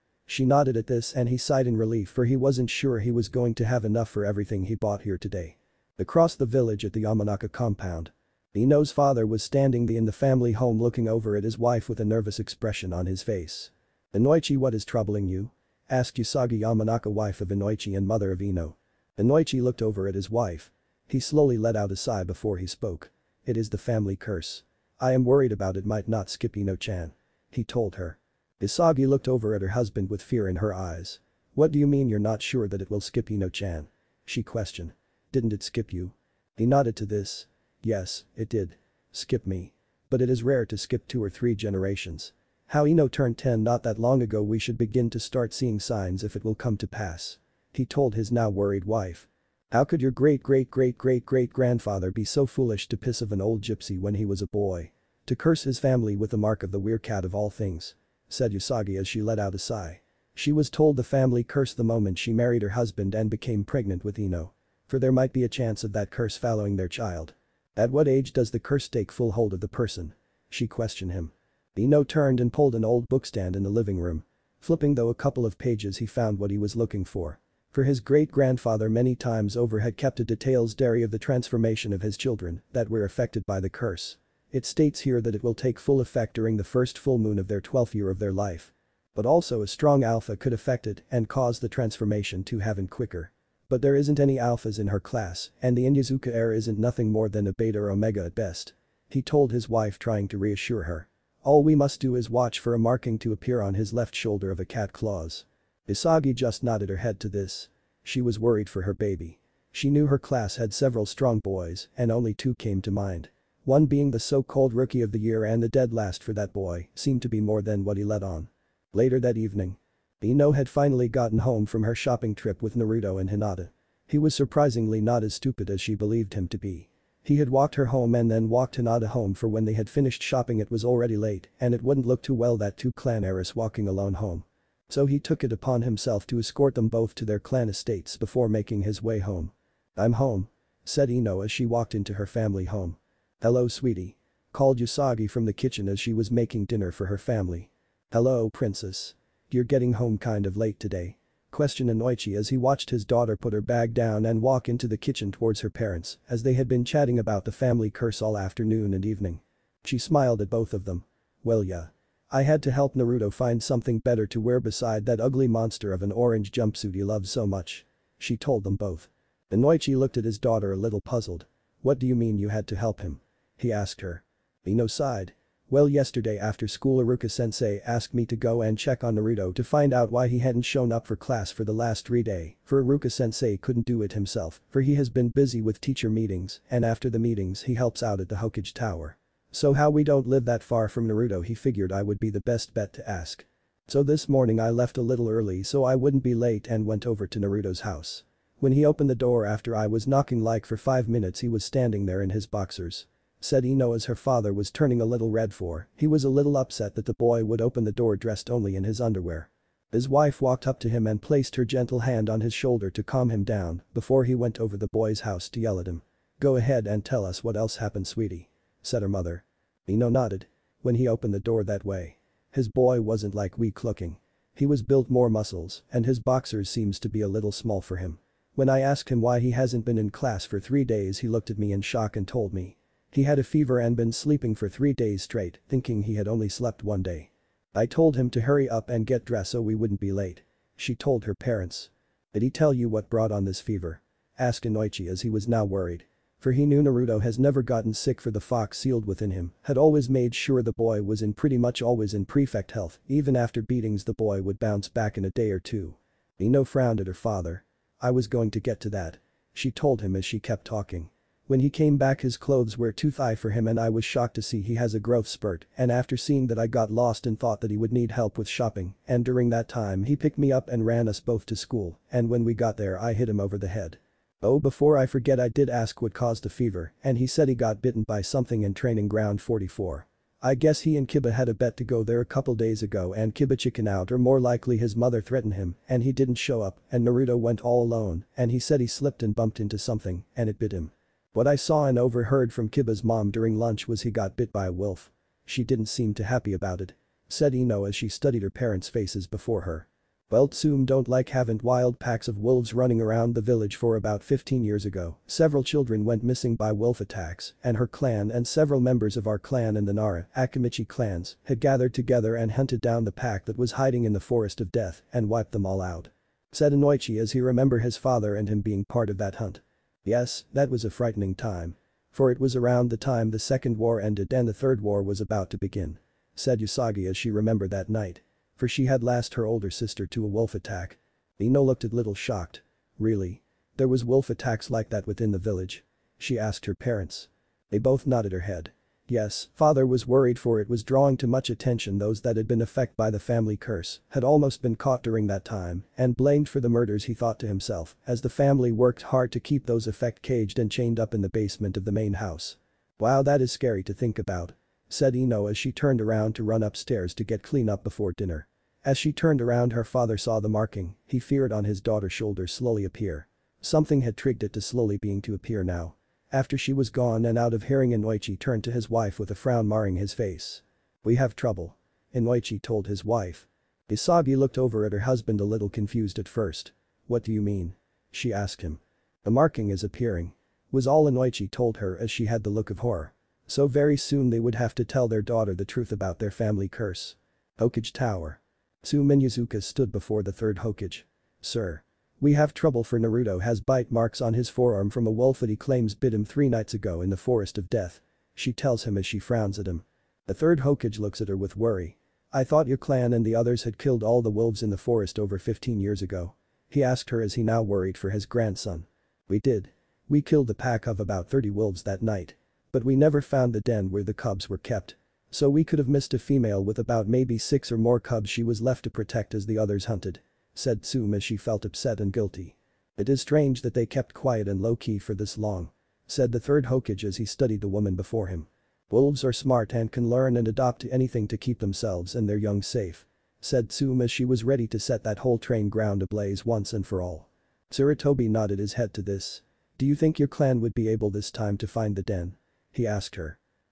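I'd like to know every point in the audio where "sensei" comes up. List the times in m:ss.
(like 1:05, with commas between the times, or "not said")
2:56, 3:02.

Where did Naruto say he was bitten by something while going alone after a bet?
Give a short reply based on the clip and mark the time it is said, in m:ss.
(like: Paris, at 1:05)
training ground 44, at 4:38.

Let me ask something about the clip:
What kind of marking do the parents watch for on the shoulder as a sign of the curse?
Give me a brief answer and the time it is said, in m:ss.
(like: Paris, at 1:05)
cat claws, at 1:44.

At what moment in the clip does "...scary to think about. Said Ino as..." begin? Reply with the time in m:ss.
5:53.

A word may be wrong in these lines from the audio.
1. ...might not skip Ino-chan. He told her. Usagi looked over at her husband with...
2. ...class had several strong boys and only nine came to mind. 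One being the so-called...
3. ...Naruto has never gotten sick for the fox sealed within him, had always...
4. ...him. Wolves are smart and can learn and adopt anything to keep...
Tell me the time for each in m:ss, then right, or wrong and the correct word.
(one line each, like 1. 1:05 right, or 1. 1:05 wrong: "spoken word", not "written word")
1. 0:25 right
2. 1:50 wrong: "two", not "nine"
3. 4:06 right
4. 7:08 right.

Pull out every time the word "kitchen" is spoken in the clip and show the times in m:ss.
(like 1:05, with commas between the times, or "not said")
2:25, 2:34.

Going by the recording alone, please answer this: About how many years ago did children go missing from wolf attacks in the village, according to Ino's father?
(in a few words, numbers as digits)
15.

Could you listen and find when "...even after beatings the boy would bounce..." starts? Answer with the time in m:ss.
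4:13.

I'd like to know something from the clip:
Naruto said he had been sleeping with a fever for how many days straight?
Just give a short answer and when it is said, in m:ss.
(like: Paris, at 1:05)
3, at 3:54.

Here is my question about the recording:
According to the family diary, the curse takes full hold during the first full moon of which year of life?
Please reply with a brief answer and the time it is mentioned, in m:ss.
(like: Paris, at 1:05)
12th, at 1:27.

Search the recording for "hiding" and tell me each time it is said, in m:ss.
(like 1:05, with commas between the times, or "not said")
5:13.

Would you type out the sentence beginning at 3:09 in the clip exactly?
So how we don't live that far from Naruto he figured I would be the best bet to ask.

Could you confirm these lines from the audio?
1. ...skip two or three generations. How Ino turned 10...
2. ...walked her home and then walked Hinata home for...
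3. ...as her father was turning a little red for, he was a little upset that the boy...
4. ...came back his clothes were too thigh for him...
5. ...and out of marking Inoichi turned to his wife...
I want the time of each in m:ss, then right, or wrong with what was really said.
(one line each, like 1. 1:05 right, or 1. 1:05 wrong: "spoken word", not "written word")
1. 0:40 right
2. 2:07 right
3. 3:23 right
4. 4:21 right
5. 6:07 wrong: "hearing", not "marking".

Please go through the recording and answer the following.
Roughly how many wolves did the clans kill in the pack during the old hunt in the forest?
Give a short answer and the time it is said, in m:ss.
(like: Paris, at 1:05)
30, at 6:50.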